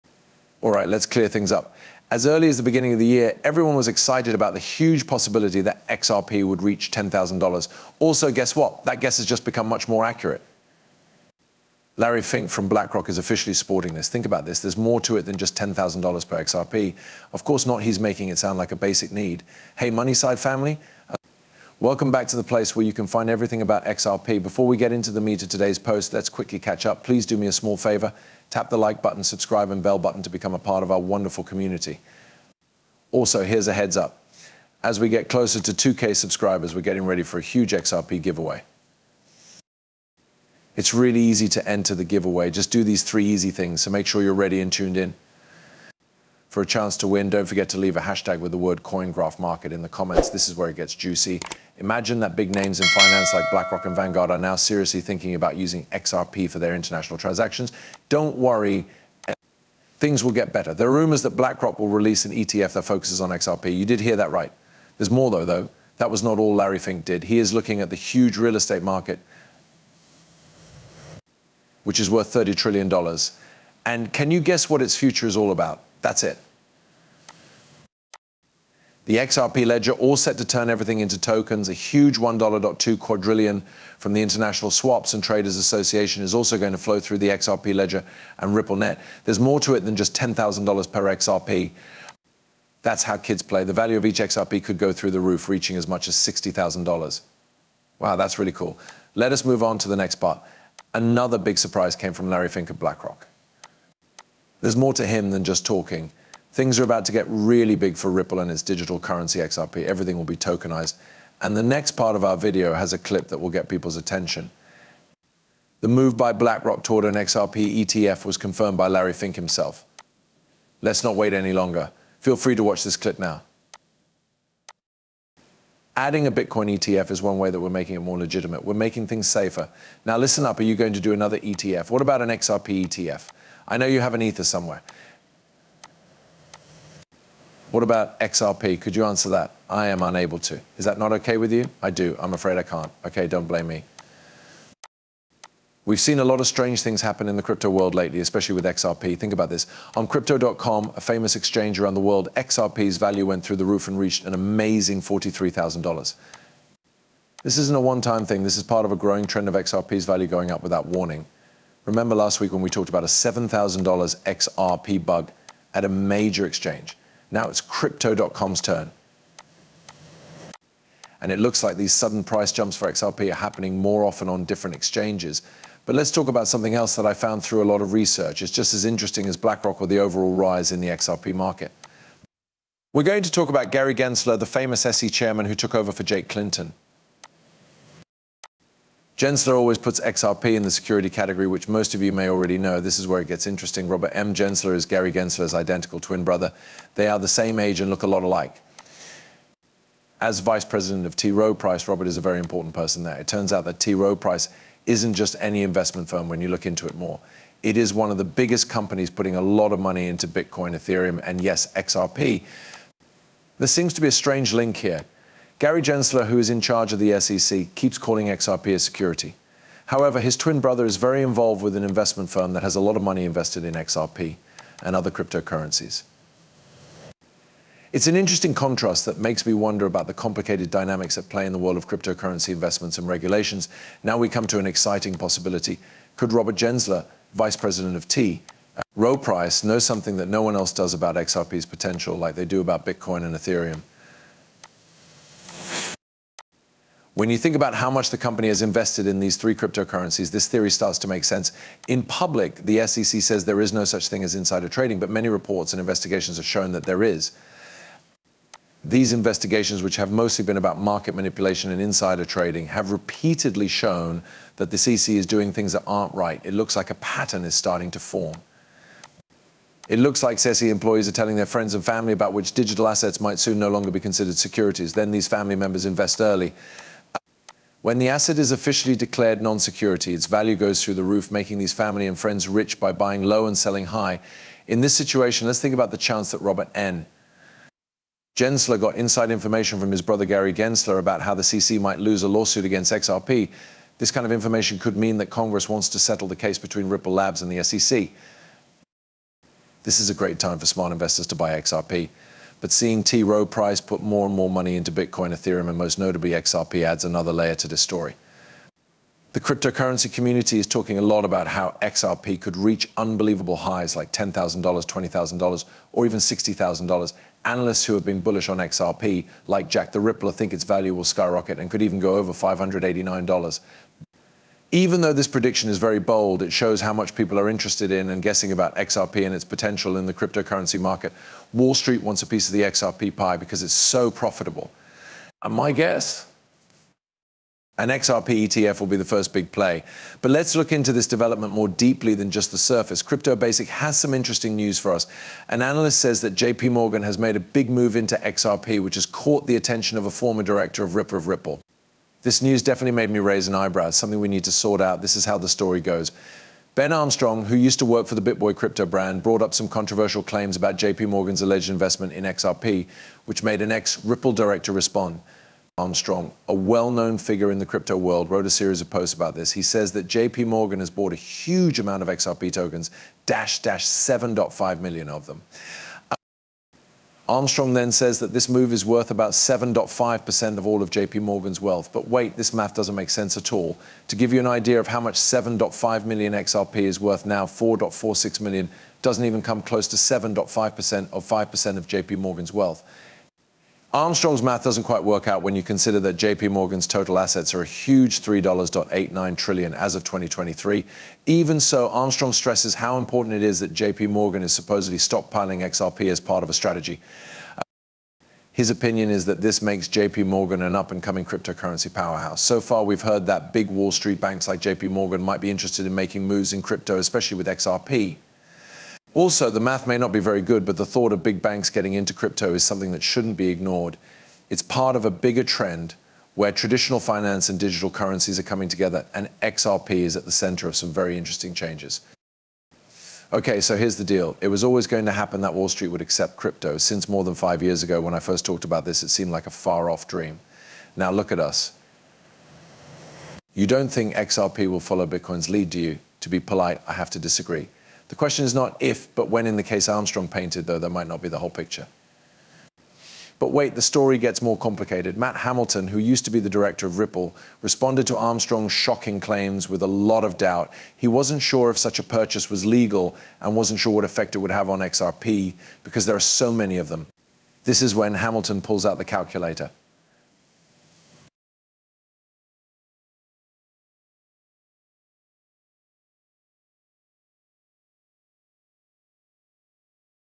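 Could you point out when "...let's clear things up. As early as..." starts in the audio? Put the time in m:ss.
0:00.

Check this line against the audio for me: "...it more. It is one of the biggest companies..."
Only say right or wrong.
right.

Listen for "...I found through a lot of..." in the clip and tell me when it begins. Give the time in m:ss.
2:57.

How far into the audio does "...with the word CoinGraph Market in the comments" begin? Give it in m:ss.
0:48.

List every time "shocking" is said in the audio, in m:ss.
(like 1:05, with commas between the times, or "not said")
7:38.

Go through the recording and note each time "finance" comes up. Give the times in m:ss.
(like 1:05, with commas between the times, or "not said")
0:52, 7:07.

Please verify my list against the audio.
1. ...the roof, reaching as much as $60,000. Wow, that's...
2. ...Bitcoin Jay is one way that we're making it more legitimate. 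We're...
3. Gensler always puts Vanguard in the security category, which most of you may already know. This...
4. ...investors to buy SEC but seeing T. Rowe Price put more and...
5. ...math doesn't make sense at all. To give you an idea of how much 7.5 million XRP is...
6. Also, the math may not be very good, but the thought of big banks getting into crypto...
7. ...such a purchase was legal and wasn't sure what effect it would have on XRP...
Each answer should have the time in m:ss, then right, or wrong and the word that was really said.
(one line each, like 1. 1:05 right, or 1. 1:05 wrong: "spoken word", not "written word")
1. 1:35 right
2. 2:06 wrong: "ETF", not "Jay"
3. 3:09 wrong: "XRP", not "Vanguard"
4. 5:00 wrong: "XRP", not "SEC"
5. 6:22 right
6. 6:59 right
7. 7:41 right.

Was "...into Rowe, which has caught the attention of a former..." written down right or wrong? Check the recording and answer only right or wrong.
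wrong.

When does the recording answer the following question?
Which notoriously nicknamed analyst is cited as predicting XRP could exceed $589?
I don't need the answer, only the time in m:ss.
5:19.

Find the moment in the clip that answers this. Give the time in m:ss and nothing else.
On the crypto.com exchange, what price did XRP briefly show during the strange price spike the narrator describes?
2:35.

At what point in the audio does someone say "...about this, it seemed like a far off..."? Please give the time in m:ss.
7:18.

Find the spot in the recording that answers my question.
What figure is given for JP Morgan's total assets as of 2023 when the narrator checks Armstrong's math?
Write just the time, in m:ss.
6:38.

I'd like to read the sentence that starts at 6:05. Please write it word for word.
Armstrong, a well known figure in the crypto world, wrote a series of posts about this.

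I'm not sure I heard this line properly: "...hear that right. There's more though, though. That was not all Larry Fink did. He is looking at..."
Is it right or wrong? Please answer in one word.
right.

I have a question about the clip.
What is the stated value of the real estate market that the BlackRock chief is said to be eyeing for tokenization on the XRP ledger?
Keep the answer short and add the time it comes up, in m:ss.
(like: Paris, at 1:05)
$30 trillion, at 1:12.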